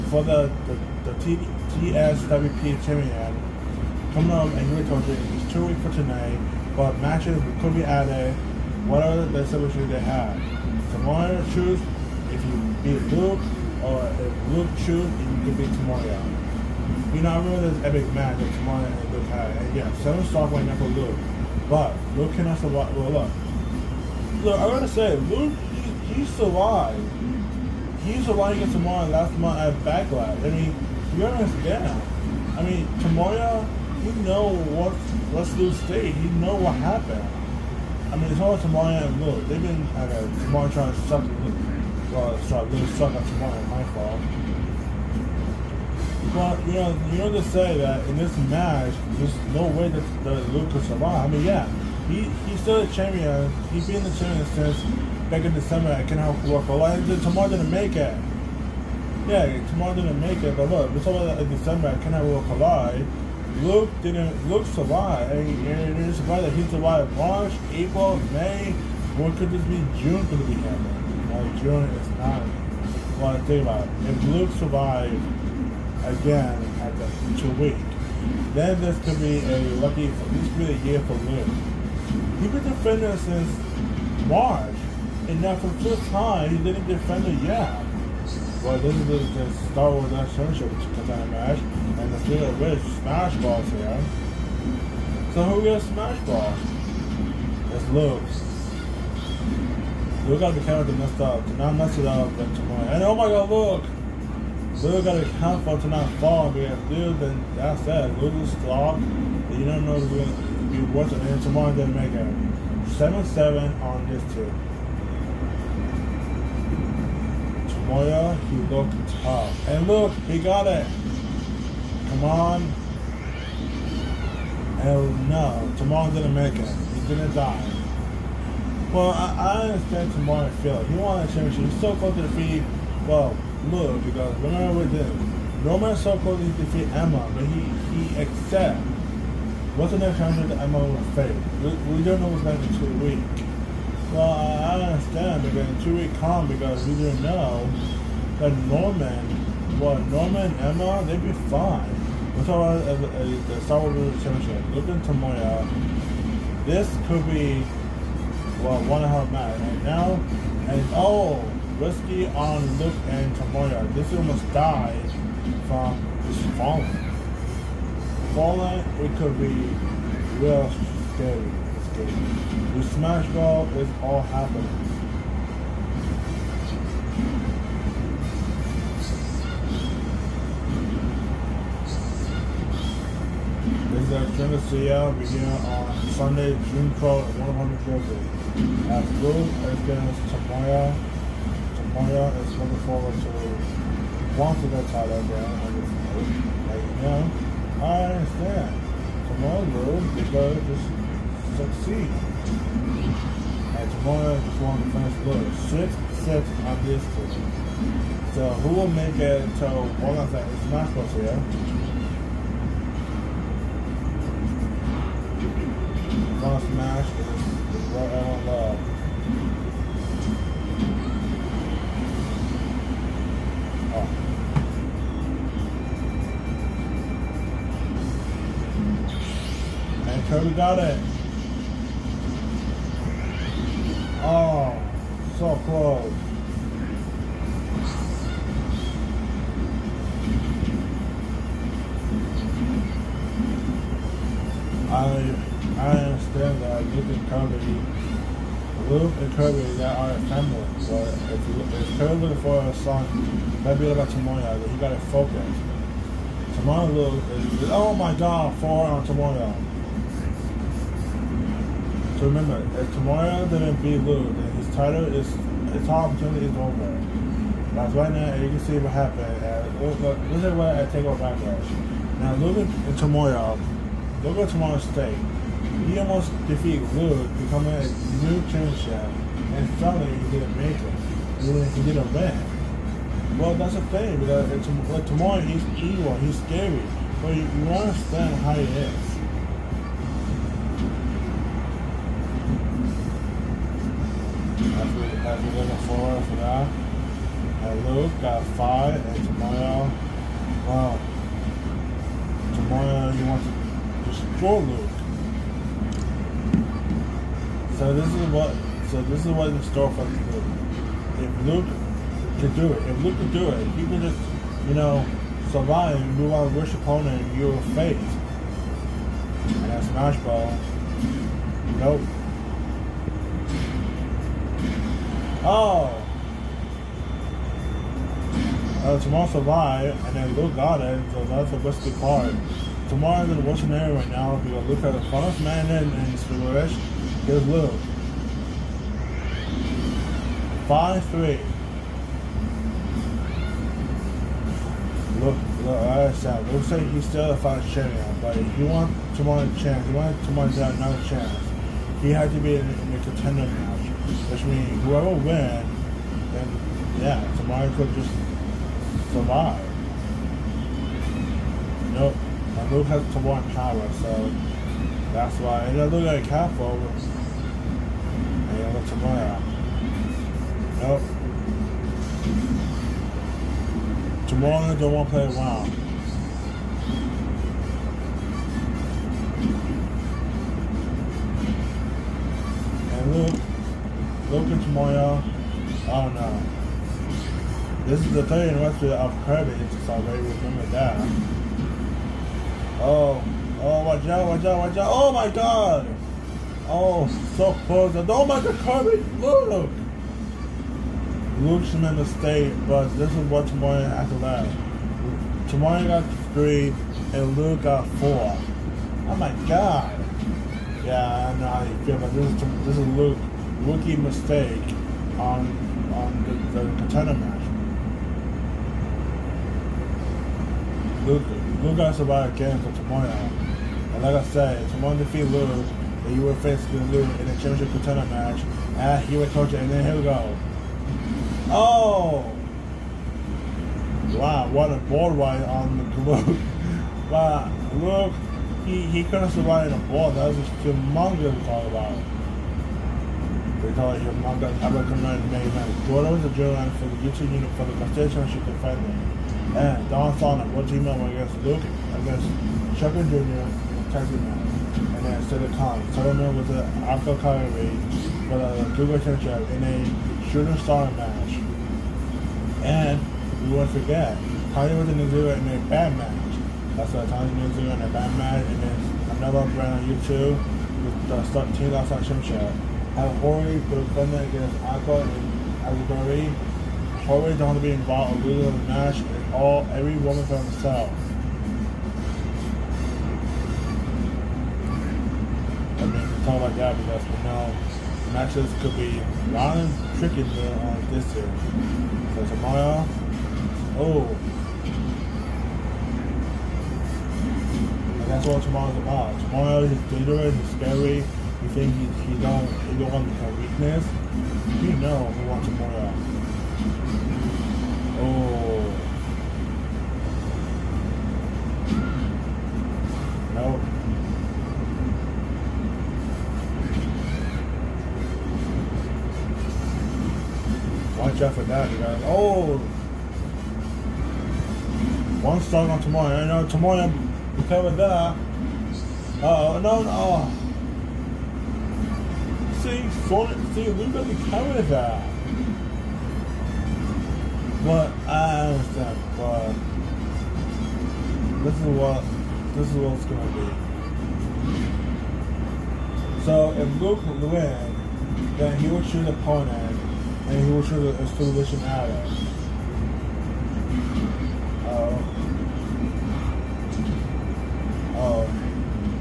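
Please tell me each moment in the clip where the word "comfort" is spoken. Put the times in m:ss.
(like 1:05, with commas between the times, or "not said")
not said.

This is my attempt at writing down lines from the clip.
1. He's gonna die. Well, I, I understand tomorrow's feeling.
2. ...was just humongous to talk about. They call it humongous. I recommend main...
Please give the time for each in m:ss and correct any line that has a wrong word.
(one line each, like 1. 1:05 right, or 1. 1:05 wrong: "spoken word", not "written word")
1. 2:06 right
2. 7:20 right.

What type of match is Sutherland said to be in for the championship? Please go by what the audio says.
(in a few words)
Shooting star match.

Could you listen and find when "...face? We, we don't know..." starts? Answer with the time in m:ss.
2:21.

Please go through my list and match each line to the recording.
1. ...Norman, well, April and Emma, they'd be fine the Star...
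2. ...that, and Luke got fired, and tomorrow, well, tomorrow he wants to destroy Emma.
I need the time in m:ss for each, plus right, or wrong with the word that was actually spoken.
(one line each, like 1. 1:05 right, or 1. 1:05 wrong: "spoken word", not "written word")
1. 2:28 wrong: "Norman", not "April"
2. 4:56 wrong: "Luke", not "Emma".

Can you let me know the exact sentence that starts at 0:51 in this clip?
I mean, yeah, he he's still a champion.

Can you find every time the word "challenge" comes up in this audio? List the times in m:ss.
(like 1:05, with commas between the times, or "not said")
2:20.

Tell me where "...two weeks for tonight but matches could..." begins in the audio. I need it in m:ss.
0:05.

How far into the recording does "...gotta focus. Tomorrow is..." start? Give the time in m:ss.
4:14.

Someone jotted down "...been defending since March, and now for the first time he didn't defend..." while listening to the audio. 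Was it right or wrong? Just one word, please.
right.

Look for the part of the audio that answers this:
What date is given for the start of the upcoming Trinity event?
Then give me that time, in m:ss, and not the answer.
3:06.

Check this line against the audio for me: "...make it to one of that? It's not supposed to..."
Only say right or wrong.
right.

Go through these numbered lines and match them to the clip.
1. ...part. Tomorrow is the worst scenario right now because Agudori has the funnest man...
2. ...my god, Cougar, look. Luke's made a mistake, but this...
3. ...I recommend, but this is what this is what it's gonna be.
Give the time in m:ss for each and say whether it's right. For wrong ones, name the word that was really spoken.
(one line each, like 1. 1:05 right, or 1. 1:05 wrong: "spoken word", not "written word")
1. 5:31 wrong: "Luke", not "Agudori"
2. 6:38 wrong: "Kirby", not "Cougar"
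3. 8:58 wrong: "understand", not "recommend".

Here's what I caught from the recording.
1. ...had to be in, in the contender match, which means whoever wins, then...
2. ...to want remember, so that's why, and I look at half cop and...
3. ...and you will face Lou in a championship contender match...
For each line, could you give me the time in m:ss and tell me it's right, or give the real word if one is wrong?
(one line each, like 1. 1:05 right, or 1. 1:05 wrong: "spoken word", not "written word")
1. 5:52 right
2. 6:03 wrong: "power", not "remember"
3. 7:05 right.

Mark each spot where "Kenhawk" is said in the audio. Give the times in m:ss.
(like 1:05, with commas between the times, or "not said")
0:56, 1:02.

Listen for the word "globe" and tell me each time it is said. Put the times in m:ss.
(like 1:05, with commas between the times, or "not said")
7:15.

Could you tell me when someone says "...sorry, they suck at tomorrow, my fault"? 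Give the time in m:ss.
0:42.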